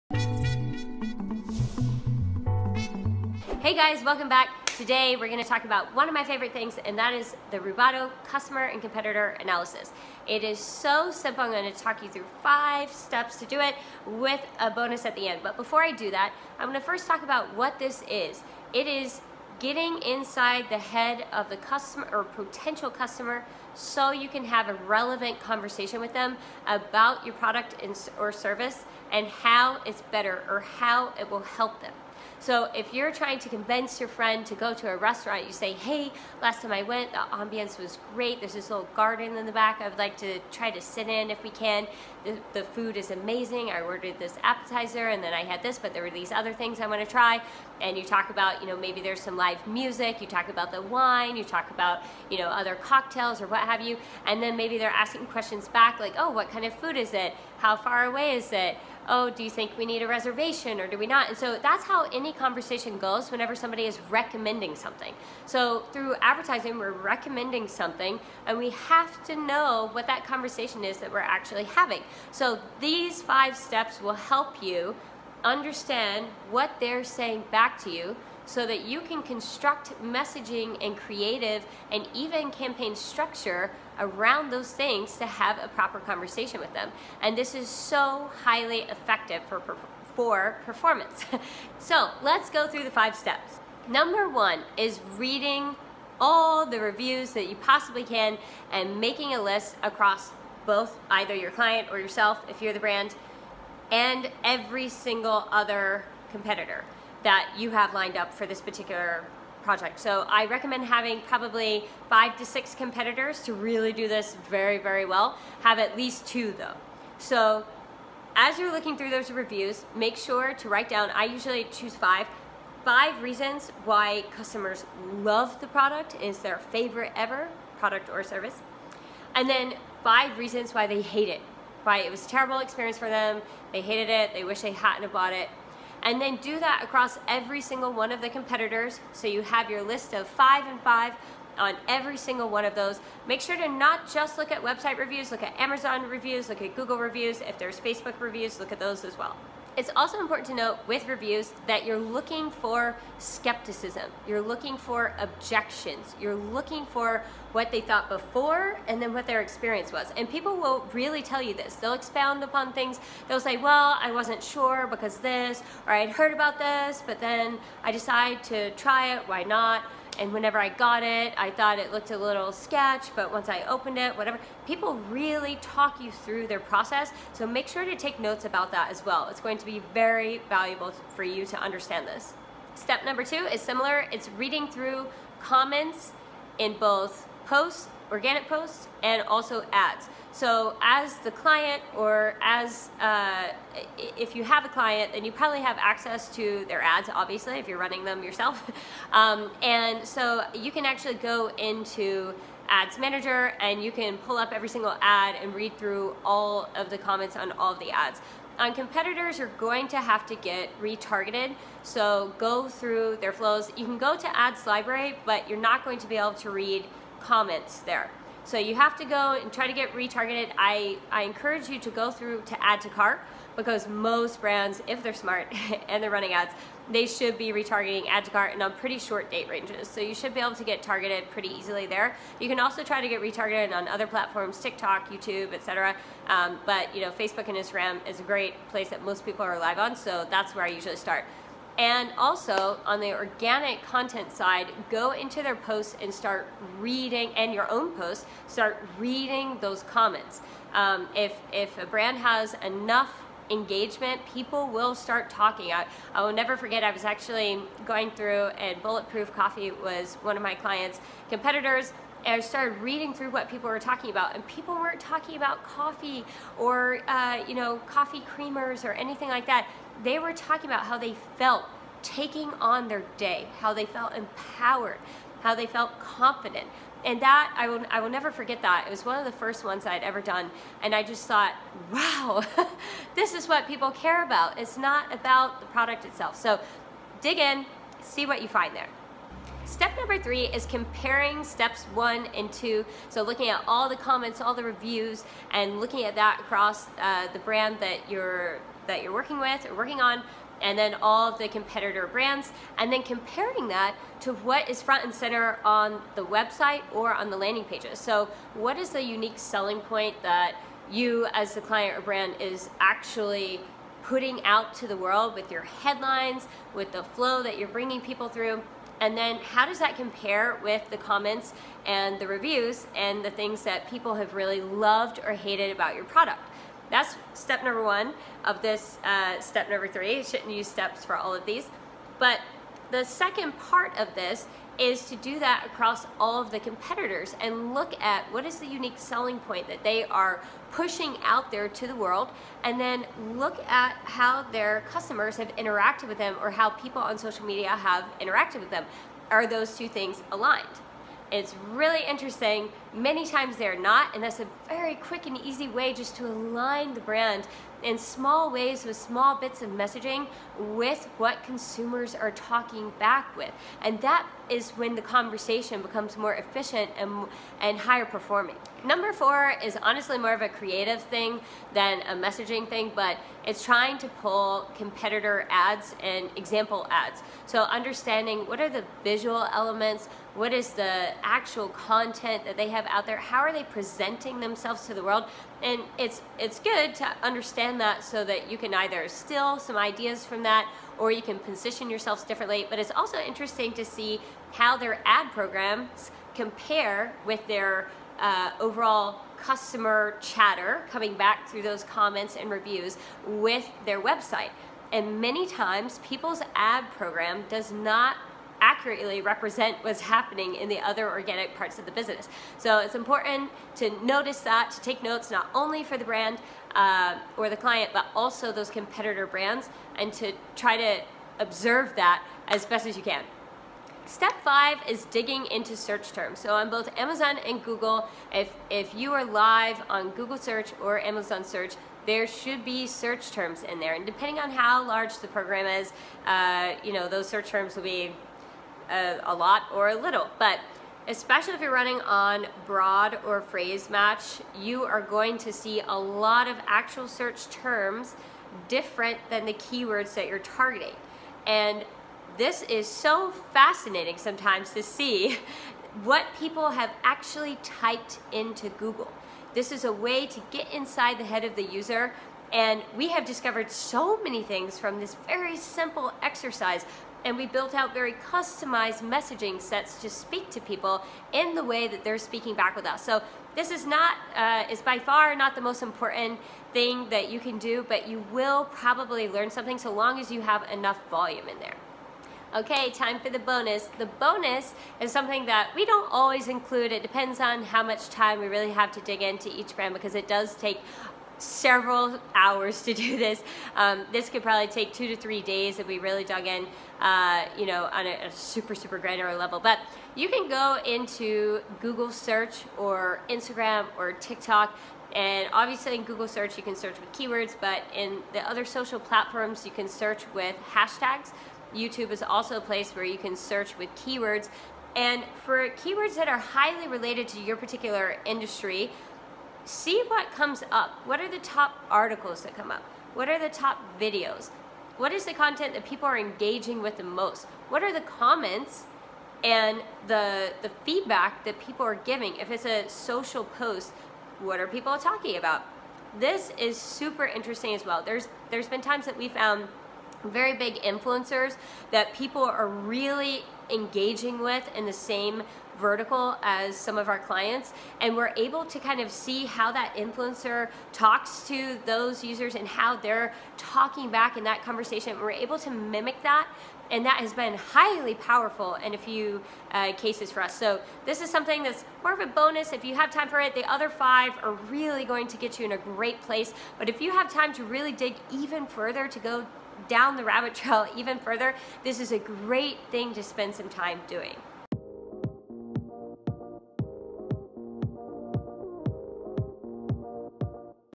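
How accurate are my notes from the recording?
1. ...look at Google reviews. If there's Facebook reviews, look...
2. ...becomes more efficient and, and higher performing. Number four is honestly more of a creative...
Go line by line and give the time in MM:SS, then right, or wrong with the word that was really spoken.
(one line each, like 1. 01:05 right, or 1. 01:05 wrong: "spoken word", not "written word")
1. 02:26 right
2. 06:05 right.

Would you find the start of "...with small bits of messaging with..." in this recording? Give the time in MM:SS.
05:58.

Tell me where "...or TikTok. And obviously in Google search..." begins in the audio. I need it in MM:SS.
08:23.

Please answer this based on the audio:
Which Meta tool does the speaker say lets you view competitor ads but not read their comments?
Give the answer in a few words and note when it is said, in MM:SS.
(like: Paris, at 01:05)
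Ads library, at 03:34.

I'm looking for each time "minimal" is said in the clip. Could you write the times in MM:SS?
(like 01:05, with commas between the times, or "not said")
not said.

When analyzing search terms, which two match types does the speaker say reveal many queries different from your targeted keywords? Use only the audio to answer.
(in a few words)
broad or phrase.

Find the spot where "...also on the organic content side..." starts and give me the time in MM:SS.
04:02.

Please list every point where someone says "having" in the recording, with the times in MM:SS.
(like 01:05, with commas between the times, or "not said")
01:11, 01:50.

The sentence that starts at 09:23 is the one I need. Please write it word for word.
The other five are really going to get you in a great place.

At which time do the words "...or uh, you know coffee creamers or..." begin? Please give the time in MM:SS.
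04:26.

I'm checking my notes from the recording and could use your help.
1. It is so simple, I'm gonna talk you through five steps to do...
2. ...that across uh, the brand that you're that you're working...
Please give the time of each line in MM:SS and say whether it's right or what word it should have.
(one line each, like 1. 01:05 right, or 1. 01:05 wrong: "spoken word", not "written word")
1. 00:10 right
2. 04:56 right.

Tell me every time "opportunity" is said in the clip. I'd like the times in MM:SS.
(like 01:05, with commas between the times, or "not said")
not said.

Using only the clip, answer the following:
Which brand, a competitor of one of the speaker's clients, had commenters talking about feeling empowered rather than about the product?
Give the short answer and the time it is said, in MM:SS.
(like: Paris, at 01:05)
Bulletproof Coffee, at 04:18.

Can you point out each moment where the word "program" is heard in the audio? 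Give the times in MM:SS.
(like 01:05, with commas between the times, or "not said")
06:35, 06:46, 07:15.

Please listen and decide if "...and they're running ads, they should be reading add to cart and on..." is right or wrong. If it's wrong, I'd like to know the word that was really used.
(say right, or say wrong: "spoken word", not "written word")
wrong: "retargeting", not "reading".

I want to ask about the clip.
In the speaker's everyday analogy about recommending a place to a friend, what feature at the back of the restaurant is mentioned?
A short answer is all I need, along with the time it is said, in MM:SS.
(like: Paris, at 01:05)
little garden, at 00:38.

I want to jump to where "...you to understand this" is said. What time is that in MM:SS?
03:01.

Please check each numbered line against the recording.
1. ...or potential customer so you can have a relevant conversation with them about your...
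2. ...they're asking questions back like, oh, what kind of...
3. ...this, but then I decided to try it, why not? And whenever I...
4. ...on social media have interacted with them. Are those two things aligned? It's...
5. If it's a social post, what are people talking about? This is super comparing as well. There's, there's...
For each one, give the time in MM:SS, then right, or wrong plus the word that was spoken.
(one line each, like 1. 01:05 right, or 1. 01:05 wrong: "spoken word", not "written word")
1. 00:22 right
2. 00:54 right
3. 02:46 right
4. 05:47 right
5. 08:52 wrong: "interesting", not "comparing".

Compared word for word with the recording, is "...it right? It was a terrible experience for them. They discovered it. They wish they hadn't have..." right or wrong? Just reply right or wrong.
wrong.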